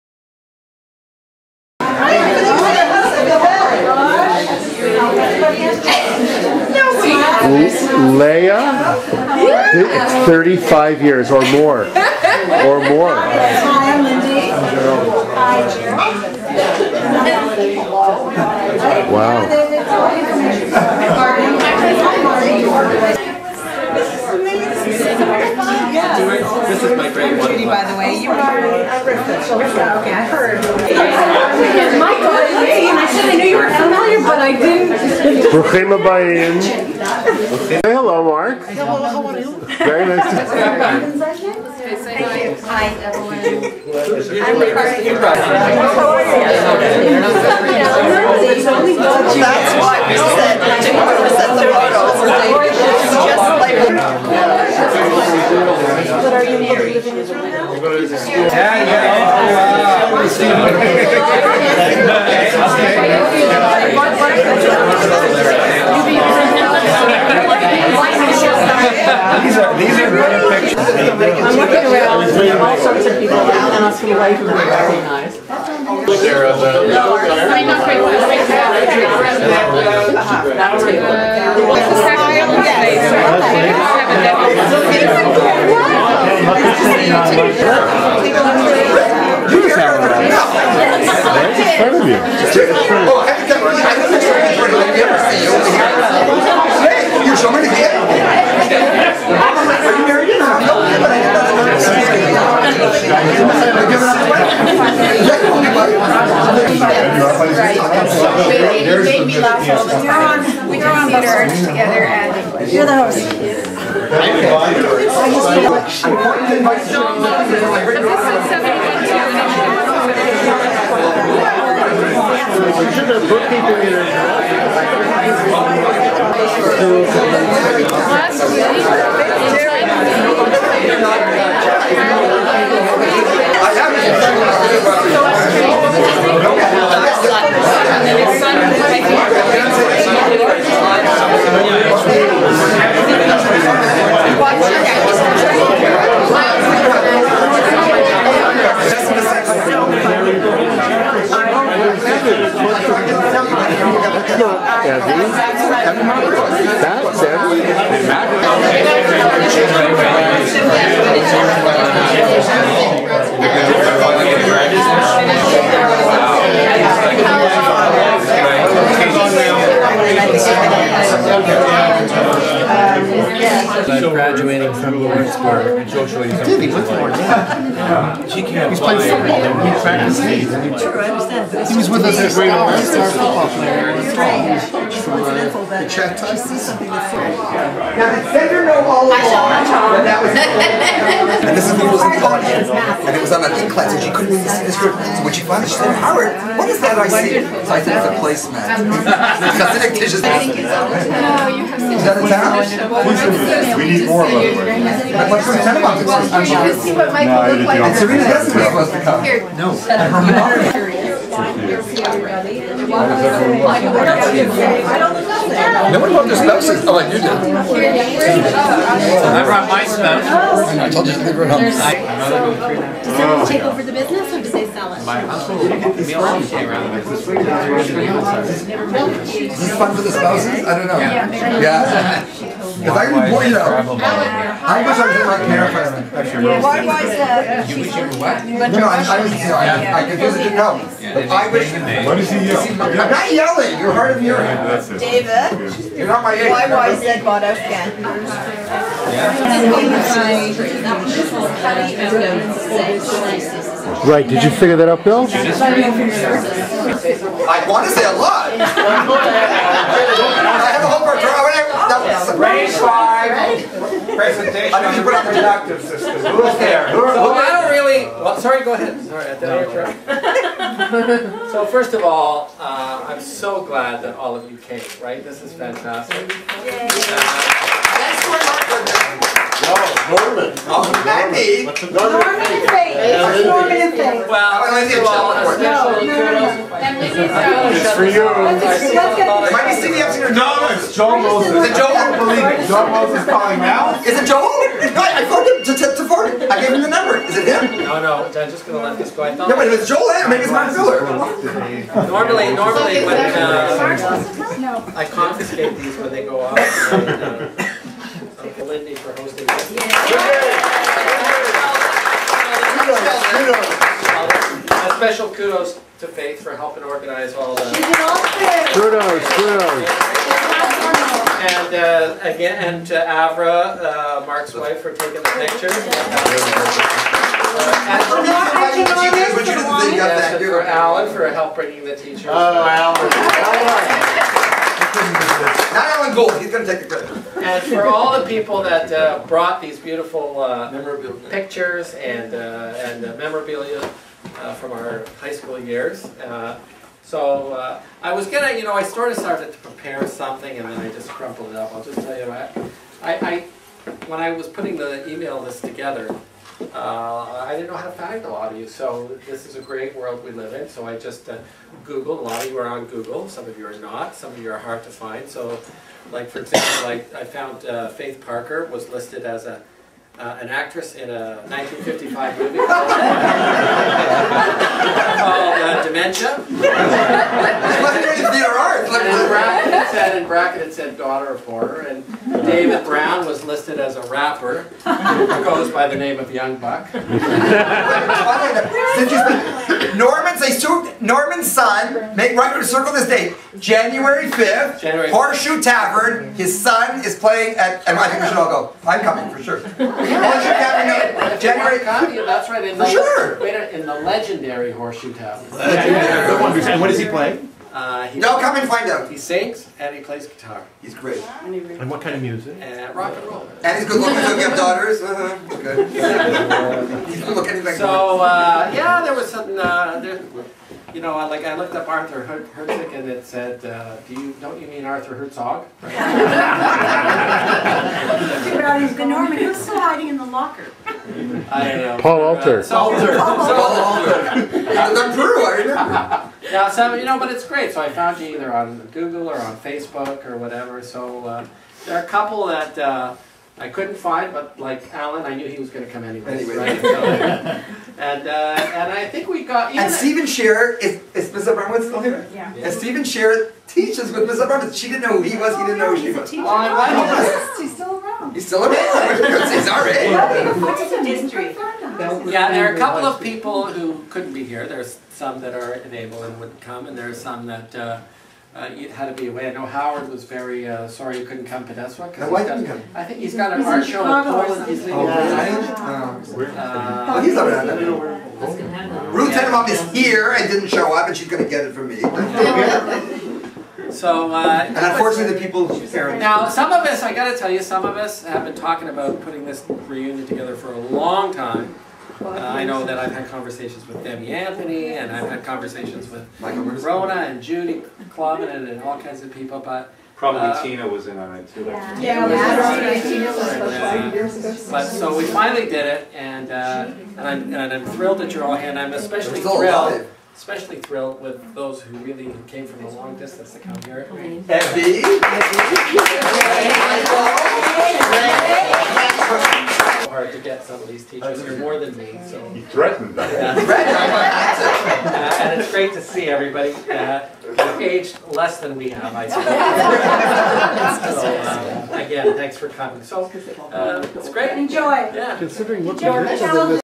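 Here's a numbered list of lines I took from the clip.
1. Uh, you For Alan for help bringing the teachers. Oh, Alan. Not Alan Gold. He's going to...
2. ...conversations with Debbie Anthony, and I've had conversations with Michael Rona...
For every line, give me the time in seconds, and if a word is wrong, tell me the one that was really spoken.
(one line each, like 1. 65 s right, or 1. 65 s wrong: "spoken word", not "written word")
1. 325 s right
2. 493 s right.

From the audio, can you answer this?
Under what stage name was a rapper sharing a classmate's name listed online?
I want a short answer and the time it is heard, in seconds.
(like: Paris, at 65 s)
Young Buck, at 386 s.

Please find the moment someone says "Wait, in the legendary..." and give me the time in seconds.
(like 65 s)
403 s.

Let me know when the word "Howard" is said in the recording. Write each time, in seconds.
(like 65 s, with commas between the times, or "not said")
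195 s, 469 s.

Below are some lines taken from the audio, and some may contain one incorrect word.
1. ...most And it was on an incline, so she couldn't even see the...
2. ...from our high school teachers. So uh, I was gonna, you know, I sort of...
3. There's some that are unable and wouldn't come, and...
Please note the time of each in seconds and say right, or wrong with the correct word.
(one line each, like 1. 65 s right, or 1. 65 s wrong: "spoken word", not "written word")
1. 191 s right
2. 344 s wrong: "years", not "teachers"
3. 464 s right.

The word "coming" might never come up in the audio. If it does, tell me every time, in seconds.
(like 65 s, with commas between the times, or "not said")
399 s, 532 s.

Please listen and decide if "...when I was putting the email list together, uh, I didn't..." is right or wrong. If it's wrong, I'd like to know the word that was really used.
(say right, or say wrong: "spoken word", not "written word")
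right.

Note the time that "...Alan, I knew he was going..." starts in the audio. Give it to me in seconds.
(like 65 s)
444 s.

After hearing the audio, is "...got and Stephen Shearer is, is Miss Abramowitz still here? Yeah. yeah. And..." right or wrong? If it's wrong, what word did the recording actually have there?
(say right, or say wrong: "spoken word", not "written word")
right.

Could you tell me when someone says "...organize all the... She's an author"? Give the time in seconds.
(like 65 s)
316 s.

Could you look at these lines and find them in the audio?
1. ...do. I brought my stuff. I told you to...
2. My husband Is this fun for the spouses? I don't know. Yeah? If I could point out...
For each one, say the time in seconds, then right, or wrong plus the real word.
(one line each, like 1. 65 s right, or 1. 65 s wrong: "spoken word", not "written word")
1. 217 s right
2. 225 s right.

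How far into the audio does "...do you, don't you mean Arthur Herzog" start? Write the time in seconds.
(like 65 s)
424 s.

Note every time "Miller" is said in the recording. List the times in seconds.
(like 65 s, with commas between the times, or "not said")
300 s.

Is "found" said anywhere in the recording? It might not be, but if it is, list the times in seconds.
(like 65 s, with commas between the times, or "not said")
367 s, 437 s.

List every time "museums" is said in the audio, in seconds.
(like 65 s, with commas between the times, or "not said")
not said.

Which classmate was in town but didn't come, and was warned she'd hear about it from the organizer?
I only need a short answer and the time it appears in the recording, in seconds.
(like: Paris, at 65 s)
Ruth Tenenbaum, at 479 s.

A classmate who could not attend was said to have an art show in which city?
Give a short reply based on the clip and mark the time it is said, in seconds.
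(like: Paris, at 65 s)
Portland, at 474 s.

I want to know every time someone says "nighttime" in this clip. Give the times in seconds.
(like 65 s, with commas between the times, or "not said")
not said.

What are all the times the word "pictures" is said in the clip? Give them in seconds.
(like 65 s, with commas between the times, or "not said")
325 s, 341 s.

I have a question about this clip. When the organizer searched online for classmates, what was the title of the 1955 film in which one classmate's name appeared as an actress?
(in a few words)
Dementia.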